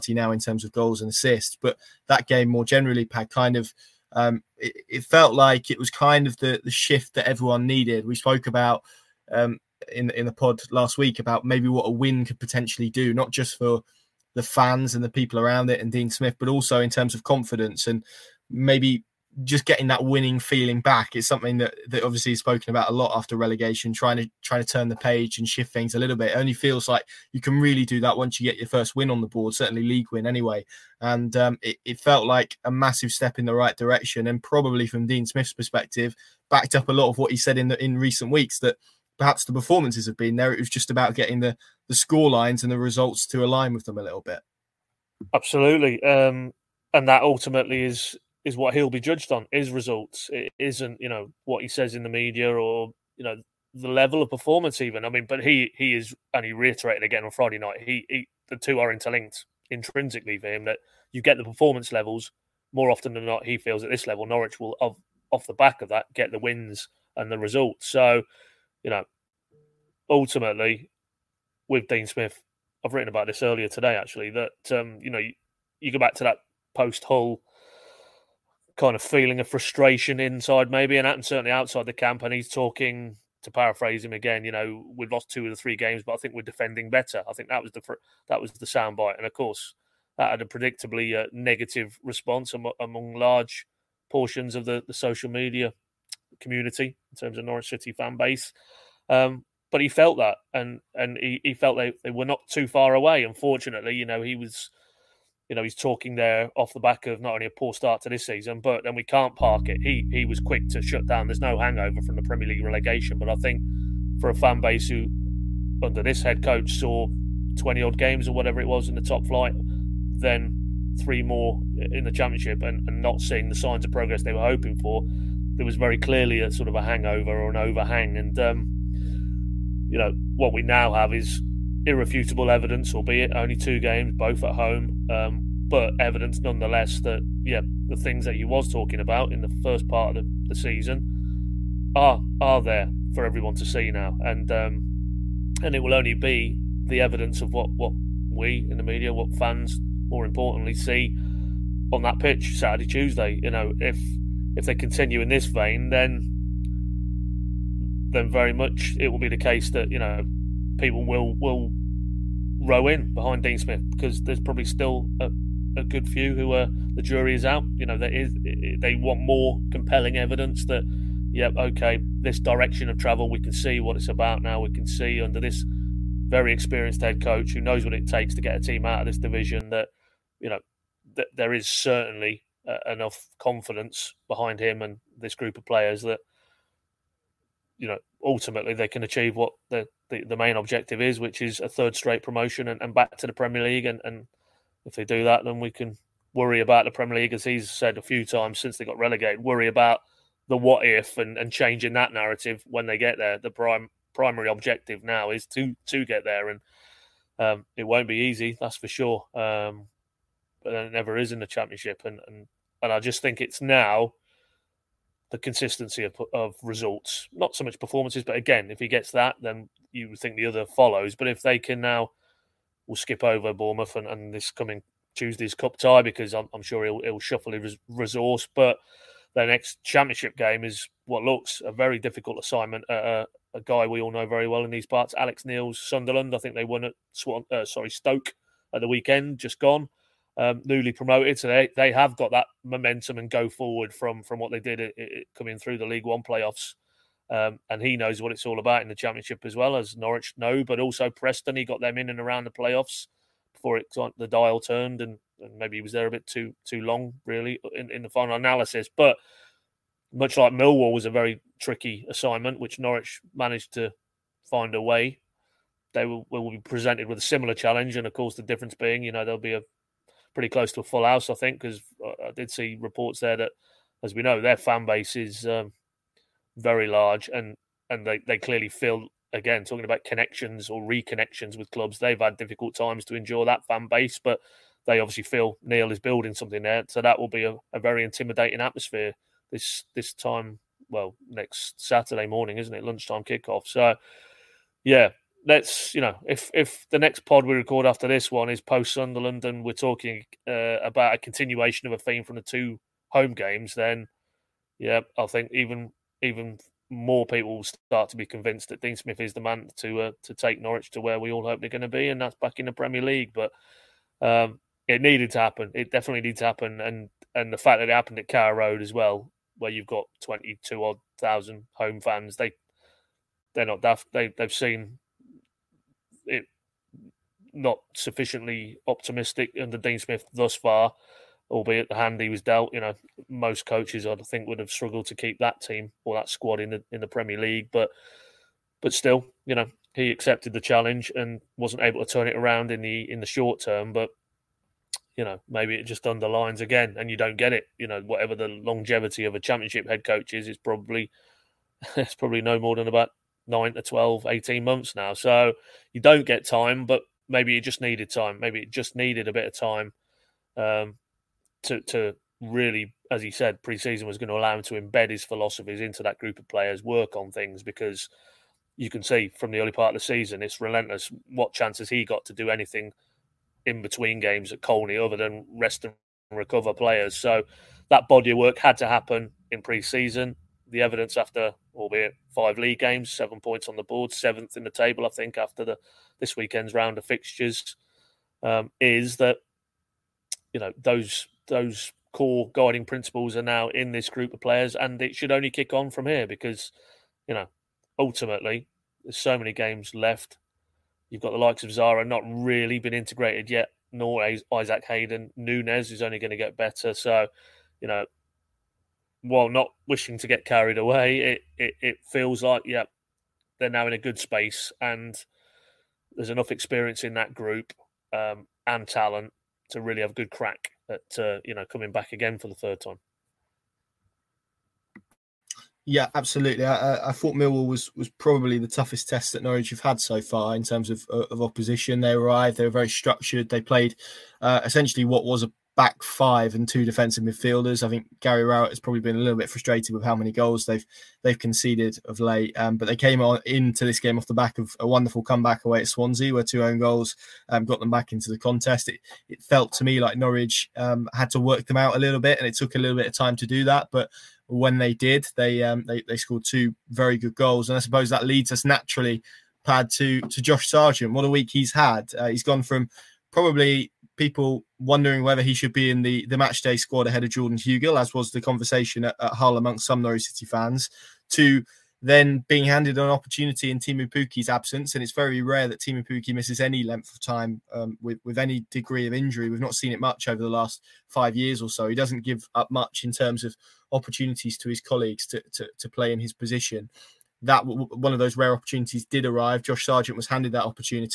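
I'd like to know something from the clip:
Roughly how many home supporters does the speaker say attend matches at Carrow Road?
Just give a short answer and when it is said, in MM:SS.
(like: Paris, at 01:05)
22,000, at 05:20.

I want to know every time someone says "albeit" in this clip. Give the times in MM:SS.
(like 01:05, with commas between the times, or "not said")
02:12, 05:31, 06:21.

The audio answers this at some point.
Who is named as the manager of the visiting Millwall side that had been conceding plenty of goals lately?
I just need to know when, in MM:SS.
07:18.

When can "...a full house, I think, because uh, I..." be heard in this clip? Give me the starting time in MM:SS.
04:30.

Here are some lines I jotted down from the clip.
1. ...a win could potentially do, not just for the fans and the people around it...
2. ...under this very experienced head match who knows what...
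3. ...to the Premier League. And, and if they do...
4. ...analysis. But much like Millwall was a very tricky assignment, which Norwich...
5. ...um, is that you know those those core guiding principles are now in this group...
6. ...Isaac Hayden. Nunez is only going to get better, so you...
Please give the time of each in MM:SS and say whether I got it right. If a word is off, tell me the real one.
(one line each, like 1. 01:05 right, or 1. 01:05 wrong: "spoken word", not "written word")
1. 00:11 right
2. 02:55 wrong: "coach", not "match"
3. 03:13 right
4. 04:18 right
5. 06:28 right
6. 06:44 right.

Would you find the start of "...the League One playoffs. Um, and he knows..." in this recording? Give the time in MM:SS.
04:05.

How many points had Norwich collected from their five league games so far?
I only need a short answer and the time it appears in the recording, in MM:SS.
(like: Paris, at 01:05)
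7, at 06:23.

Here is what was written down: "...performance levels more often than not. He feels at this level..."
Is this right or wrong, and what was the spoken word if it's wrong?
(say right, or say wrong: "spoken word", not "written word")
right.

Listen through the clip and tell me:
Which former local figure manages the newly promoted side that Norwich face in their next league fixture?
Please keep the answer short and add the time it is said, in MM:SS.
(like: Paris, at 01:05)
Alex Neil, at 03:55.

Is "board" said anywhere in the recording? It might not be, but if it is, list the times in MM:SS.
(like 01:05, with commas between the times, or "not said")
00:29, 06:23.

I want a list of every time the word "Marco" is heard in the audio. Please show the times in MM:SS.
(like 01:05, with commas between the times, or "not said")
not said.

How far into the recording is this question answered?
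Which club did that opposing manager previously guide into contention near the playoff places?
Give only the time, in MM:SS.
04:11.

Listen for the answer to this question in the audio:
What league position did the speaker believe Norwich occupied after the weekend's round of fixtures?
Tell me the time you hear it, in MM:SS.
06:24.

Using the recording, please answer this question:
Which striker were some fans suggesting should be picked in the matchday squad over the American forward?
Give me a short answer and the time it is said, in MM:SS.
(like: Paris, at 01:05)
Jordan Hugill, at 07:47.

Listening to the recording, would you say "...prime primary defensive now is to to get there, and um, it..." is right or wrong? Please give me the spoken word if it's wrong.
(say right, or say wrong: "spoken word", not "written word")
wrong: "objective", not "defensive".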